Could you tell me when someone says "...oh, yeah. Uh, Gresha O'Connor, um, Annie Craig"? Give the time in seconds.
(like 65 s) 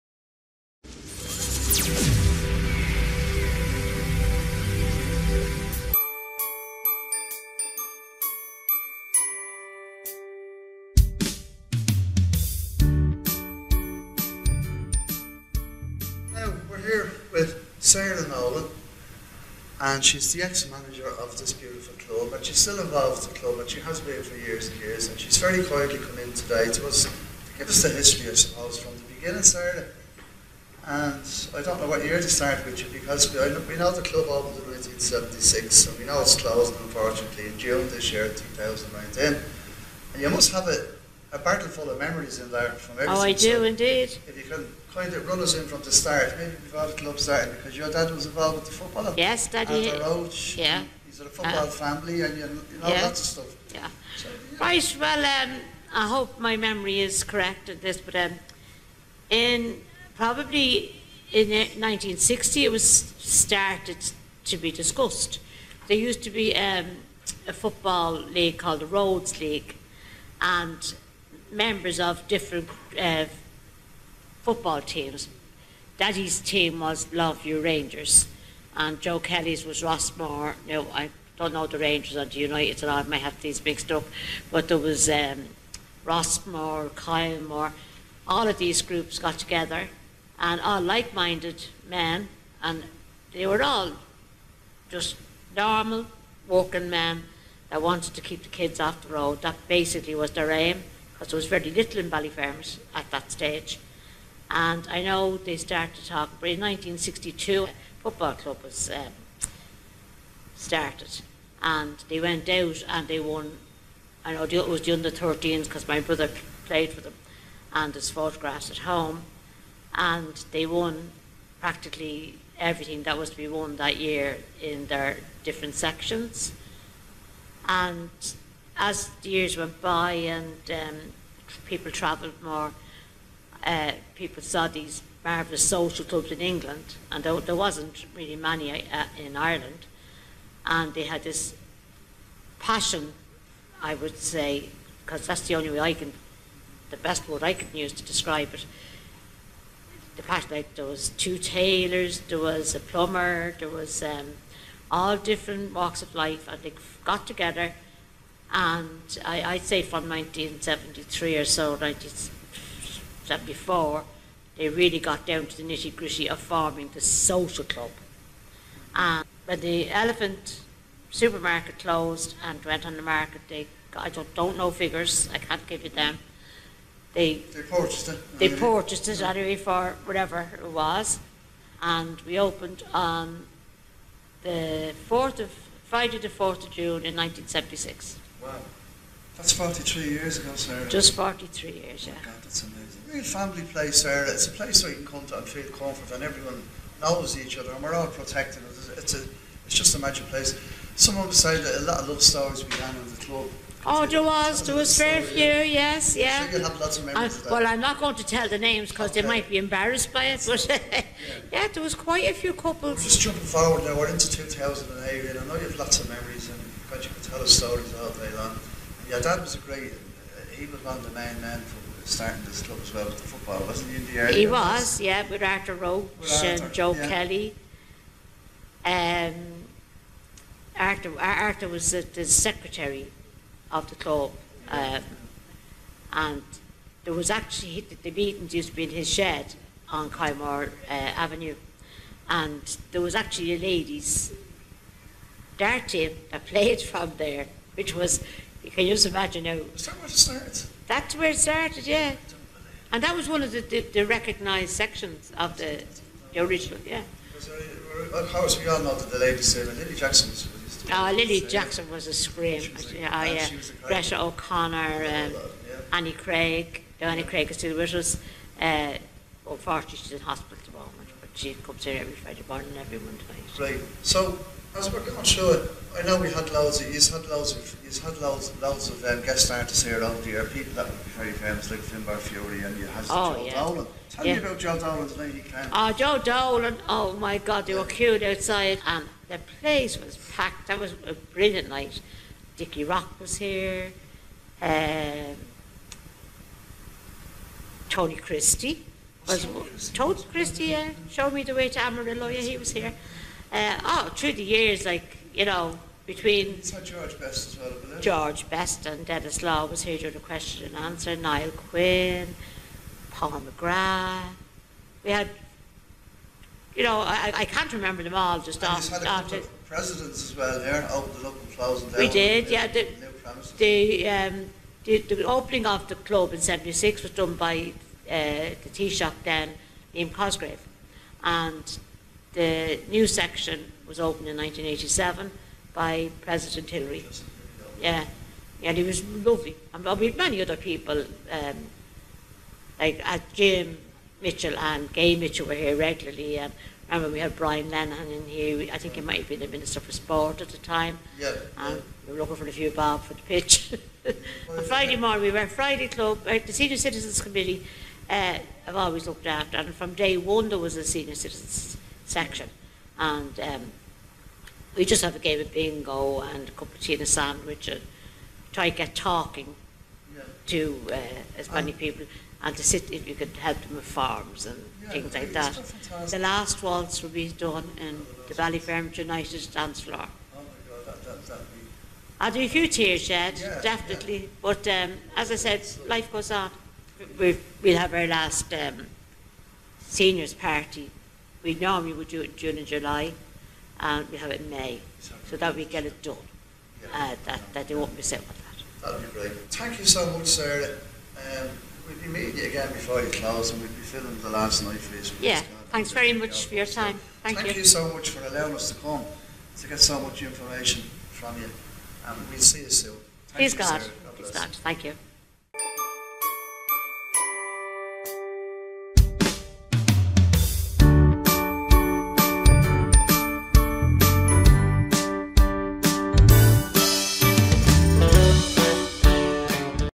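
262 s.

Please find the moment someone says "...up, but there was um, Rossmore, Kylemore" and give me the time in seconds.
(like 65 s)
83 s.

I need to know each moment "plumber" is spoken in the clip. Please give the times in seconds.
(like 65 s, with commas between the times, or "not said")
152 s.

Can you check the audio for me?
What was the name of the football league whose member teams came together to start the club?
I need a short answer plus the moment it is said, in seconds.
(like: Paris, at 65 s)
Rhodes League, at 68 s.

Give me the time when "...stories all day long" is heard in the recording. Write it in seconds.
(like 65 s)
217 s.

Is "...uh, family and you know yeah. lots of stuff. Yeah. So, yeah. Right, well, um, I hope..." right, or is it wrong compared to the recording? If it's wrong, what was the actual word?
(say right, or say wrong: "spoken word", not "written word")
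right.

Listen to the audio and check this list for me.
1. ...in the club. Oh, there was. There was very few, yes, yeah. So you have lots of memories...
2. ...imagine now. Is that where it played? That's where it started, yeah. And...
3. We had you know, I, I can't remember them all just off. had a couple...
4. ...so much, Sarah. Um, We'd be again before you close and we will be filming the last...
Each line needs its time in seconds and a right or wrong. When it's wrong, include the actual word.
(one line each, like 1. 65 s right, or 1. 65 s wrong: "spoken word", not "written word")
1. 202 s right
2. 249 s wrong: "started", not "played"
3. 315 s right
4. 399 s right.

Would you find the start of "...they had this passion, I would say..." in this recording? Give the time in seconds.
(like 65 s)
140 s.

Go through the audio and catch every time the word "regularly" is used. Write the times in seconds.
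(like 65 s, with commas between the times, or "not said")
345 s.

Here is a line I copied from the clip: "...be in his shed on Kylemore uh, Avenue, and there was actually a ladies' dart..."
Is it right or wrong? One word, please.
right.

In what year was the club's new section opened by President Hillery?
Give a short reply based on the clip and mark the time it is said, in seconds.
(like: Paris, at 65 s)
1987, at 334 s.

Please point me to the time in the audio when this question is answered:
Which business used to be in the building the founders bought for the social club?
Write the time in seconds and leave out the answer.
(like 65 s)
169 s.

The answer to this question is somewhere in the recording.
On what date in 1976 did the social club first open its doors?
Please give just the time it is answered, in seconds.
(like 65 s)
185 s.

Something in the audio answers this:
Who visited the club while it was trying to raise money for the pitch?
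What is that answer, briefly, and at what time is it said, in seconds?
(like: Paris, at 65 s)
Brian Lennon, at 347 s.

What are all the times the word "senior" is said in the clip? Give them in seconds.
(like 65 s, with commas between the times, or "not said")
356 s, 360 s, 389 s.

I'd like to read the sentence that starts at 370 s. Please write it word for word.
to uh, as many people and to sit if you could help them with farms and yeah, things like that.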